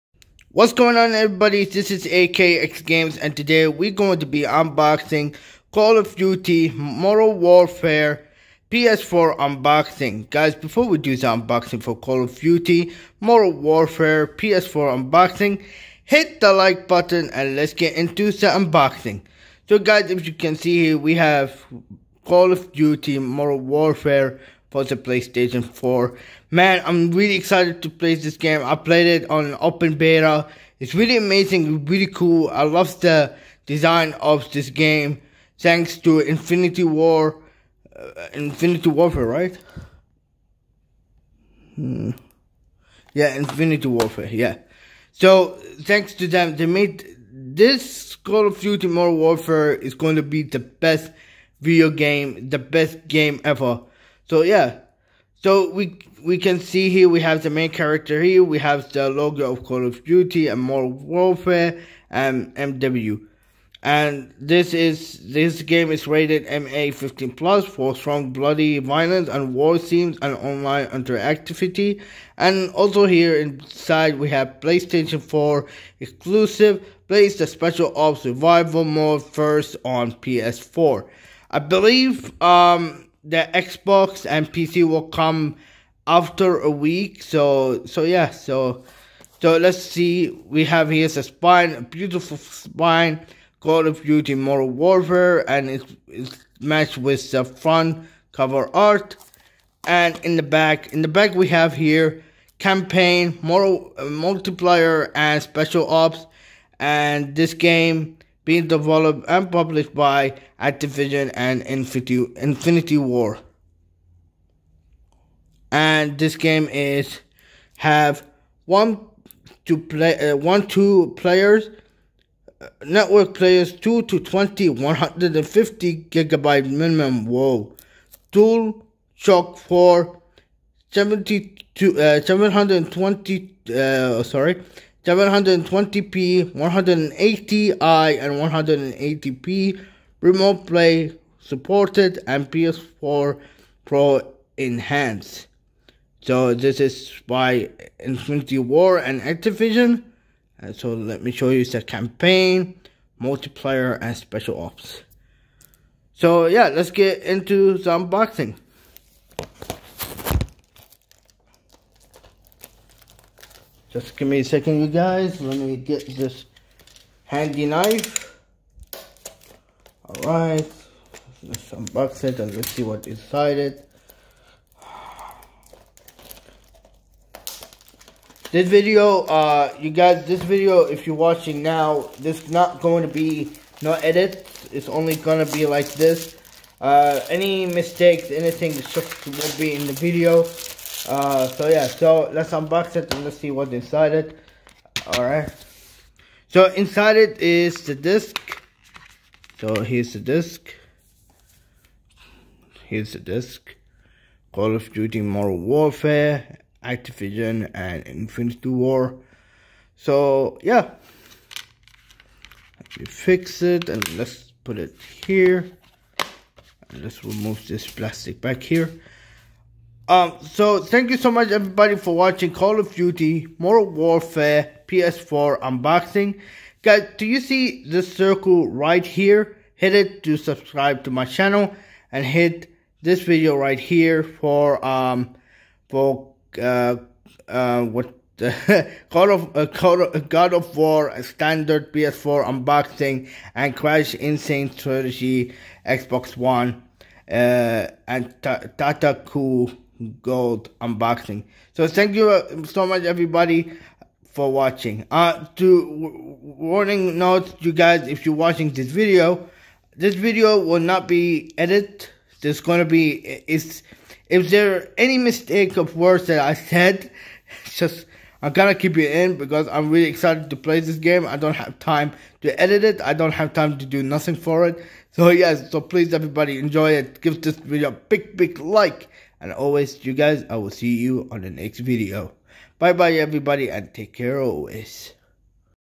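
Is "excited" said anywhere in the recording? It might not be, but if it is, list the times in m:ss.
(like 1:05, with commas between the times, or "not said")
0:27, 4:30.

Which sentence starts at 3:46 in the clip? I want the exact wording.
Guys, do you see this circle right here?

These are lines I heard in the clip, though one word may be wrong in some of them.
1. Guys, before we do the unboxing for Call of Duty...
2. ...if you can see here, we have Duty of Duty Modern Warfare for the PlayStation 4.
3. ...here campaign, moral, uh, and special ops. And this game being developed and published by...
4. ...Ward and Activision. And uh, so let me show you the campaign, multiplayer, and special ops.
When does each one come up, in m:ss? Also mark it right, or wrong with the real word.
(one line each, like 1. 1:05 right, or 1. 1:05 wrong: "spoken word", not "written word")
1. 0:10 right
2. 0:20 wrong: "Call", not "Duty"
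3. 1:41 right
4. 2:28 right.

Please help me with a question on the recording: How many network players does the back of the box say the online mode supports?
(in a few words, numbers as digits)
2 to 20.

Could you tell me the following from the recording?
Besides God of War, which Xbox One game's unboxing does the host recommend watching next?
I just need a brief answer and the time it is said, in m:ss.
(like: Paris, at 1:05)
Crash N. Sane Trilogy, at 4:03.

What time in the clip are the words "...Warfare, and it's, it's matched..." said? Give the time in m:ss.
1:34.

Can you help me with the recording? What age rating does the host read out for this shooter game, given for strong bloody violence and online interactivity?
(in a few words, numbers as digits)
MA15+.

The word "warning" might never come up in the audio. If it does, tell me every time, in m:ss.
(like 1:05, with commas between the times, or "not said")
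4:16.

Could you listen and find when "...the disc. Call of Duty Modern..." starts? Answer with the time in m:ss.
3:23.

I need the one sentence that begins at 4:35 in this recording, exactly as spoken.
So yes, so please everybody enjoy it.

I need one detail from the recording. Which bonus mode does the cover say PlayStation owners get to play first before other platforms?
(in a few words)
Special ops survival mode.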